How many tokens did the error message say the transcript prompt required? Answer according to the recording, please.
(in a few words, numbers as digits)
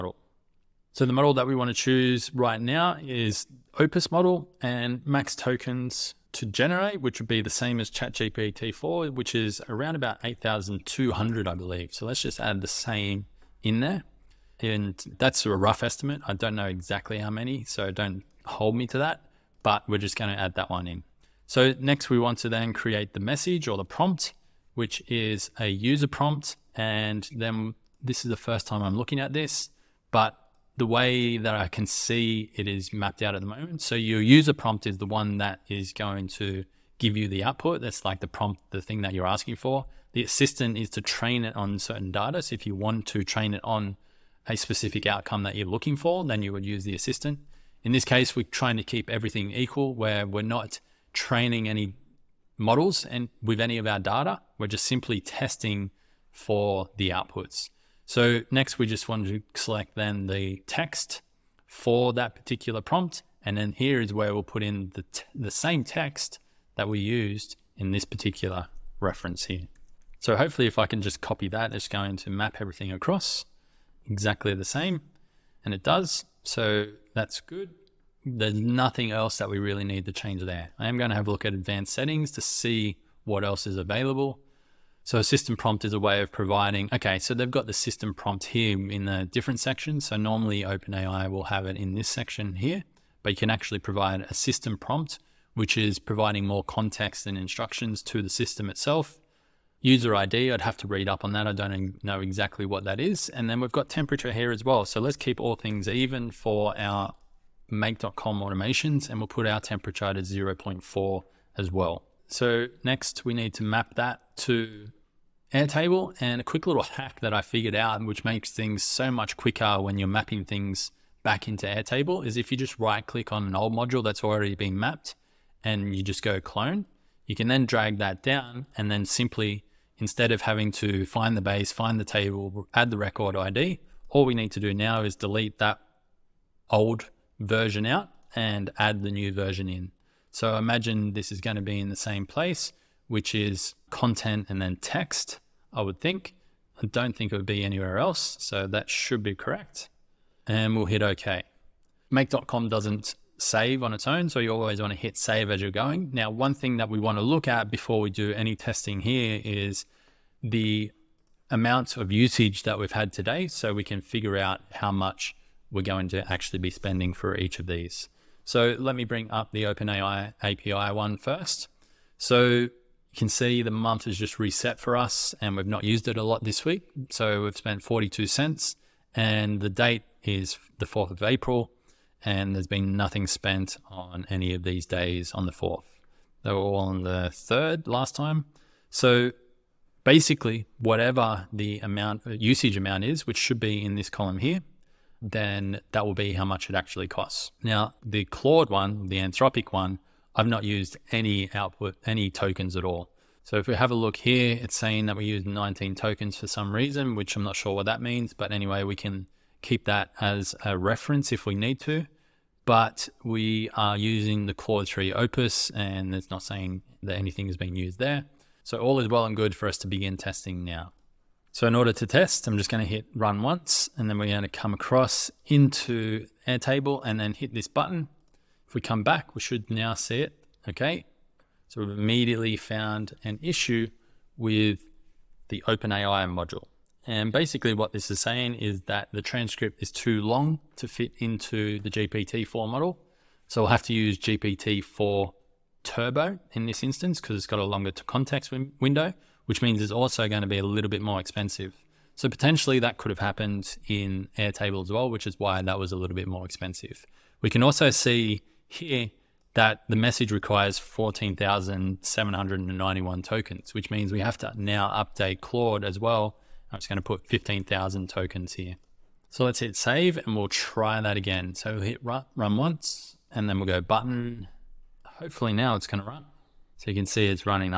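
14,791.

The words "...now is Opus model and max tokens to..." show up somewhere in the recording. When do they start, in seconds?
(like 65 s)
2 s.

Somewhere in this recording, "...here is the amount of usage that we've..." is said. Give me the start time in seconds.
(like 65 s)
159 s.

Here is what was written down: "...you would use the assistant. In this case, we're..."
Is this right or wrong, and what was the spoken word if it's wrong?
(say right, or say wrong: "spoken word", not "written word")
right.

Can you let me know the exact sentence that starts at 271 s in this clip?
So we'll hit run, run once and then we'll go button.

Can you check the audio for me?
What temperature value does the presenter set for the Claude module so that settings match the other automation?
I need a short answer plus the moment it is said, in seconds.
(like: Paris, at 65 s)
0.4, at 110 s.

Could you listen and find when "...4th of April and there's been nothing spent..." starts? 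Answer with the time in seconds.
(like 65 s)
180 s.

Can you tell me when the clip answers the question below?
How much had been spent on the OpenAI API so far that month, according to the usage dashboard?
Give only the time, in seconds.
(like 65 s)
177 s.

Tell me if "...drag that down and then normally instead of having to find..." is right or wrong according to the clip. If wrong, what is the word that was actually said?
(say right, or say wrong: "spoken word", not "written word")
wrong: "simply", not "normally".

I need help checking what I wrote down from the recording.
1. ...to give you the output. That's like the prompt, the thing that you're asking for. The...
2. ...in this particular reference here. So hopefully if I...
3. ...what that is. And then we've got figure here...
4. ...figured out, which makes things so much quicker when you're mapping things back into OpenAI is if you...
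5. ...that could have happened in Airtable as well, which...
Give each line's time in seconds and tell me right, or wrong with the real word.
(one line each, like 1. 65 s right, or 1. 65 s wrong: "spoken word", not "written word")
1. 36 s right
2. 67 s right
3. 102 s wrong: "temperature", not "figure"
4. 117 s wrong: "Airtable", not "OpenAI"
5. 252 s right.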